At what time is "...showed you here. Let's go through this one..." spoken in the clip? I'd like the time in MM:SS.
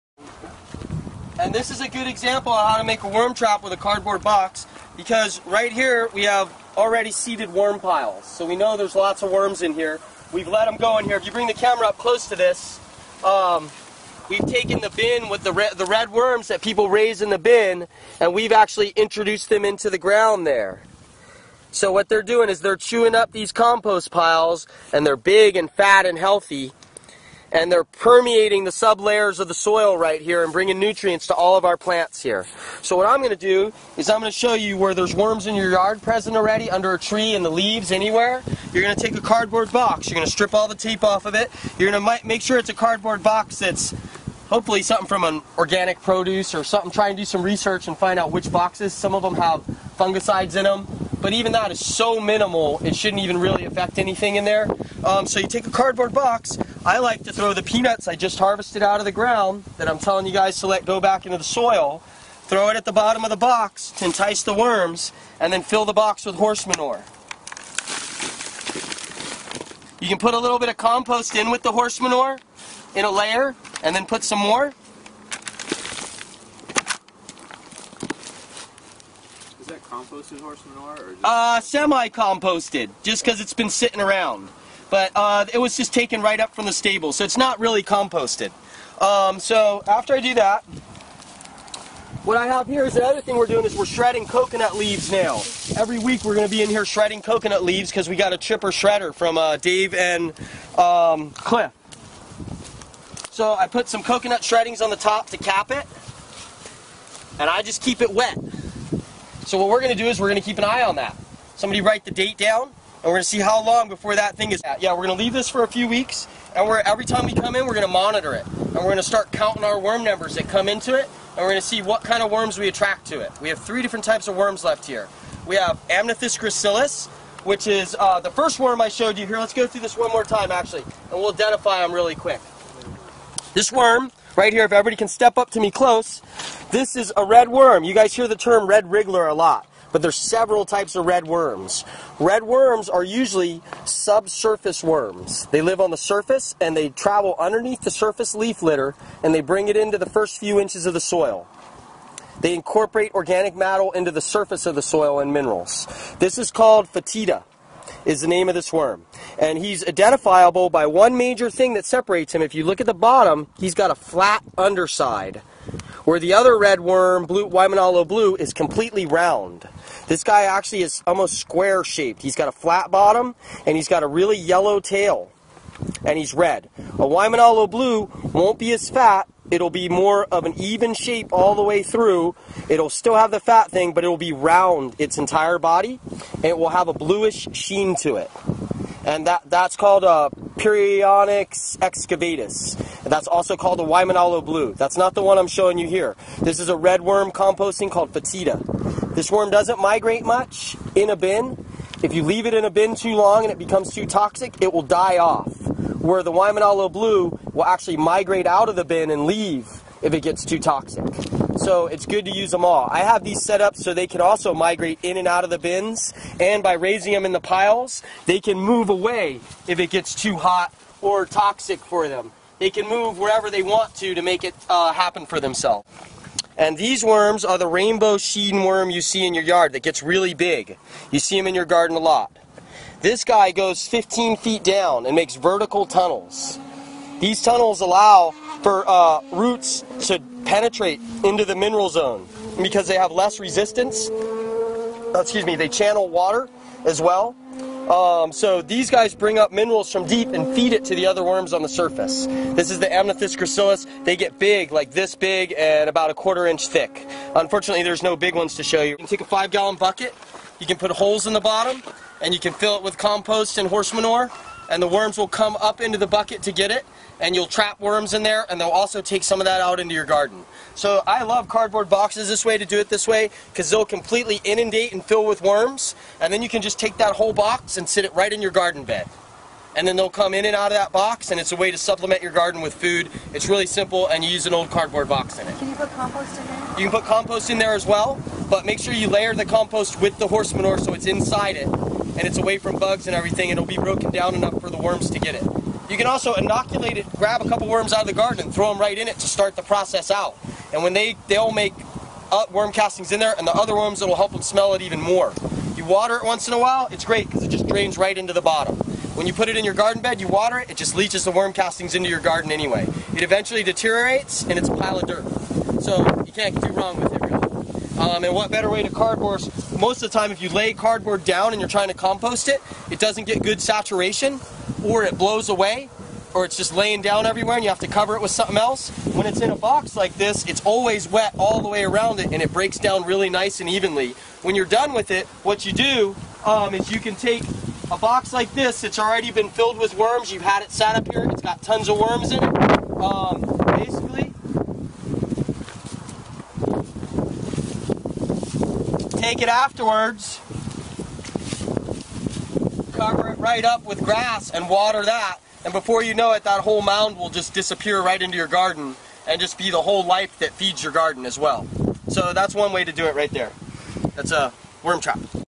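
02:08.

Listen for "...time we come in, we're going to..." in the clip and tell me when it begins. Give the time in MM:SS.
01:57.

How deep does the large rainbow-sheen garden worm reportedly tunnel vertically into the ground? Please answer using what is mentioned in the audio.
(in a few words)
15 feet.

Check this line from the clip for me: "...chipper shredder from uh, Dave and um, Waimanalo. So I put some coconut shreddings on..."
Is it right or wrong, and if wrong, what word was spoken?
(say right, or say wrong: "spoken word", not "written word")
wrong: "Cliff", not "Waimanalo".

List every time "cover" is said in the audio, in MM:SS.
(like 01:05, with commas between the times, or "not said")
05:27, 05:52.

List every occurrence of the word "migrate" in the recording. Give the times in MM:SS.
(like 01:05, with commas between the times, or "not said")
03:19, 03:27, 03:34.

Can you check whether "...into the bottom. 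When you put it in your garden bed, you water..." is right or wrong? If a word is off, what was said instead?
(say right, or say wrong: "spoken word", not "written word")
right.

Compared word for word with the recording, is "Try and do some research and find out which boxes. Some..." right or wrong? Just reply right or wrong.
right.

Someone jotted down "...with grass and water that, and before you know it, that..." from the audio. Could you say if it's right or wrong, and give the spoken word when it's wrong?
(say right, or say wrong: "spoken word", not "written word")
right.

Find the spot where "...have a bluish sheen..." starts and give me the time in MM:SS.
03:06.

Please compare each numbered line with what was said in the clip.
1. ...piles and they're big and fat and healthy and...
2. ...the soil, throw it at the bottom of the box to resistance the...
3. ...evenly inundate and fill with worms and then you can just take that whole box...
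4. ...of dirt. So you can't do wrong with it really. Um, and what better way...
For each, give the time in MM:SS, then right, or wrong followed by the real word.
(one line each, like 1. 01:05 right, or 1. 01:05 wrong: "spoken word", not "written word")
1. 00:24 right
2. 01:01 wrong: "entice", not "resistance"
3. 04:33 wrong: "completely", not "evenly"
4. 05:14 right.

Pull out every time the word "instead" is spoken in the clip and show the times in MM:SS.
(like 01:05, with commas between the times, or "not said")
not said.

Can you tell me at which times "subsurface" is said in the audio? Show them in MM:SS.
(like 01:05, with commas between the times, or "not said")
02:23.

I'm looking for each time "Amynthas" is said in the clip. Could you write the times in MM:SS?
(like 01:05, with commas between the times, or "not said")
02:05, 04:12.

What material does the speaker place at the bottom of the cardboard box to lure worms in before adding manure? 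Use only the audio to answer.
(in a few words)
Peanuts.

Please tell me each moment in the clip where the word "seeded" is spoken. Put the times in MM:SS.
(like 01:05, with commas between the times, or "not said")
00:07.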